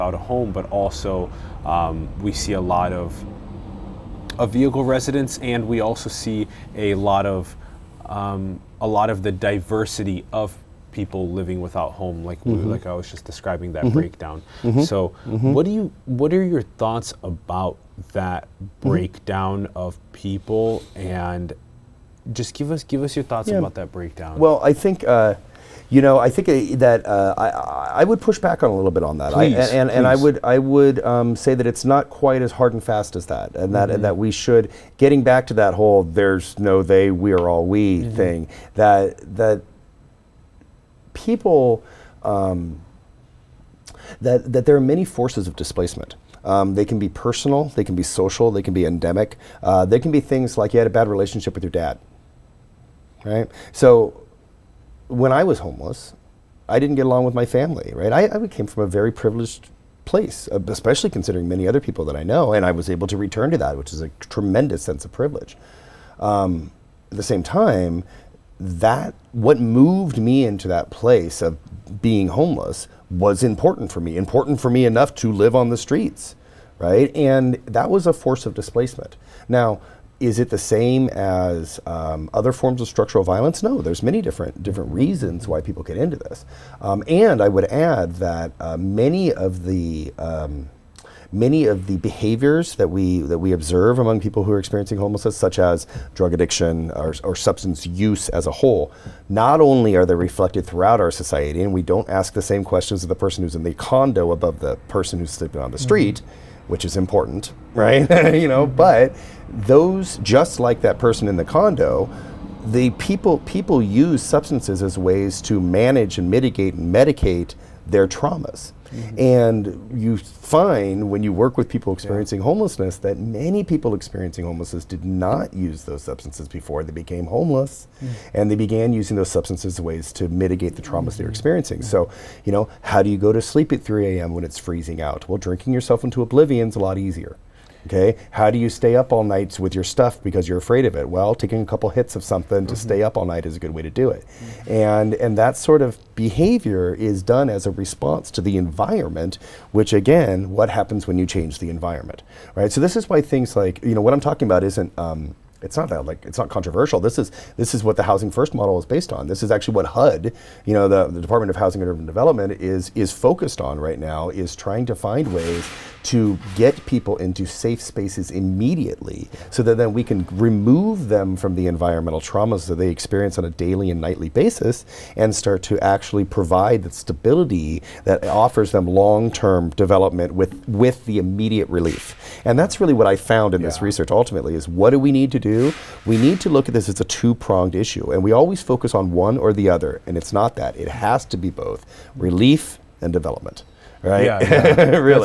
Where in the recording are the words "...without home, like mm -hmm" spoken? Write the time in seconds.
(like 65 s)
11 s.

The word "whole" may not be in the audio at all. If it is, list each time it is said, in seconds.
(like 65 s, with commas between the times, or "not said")
35 s, 98 s.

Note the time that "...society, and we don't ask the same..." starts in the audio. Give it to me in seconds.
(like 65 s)
101 s.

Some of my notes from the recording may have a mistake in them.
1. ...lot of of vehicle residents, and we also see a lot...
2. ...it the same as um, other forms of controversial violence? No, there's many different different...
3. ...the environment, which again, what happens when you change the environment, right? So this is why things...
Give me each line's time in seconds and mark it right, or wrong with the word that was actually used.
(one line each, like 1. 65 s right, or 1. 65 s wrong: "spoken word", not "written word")
1. 2 s right
2. 80 s wrong: "structural", not "controversial"
3. 148 s right.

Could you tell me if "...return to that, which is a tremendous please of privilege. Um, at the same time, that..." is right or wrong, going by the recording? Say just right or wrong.
wrong.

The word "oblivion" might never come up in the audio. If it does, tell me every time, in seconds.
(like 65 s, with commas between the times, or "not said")
136 s.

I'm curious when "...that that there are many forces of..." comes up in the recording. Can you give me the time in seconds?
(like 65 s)
44 s.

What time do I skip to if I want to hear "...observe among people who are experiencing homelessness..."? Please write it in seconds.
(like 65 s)
93 s.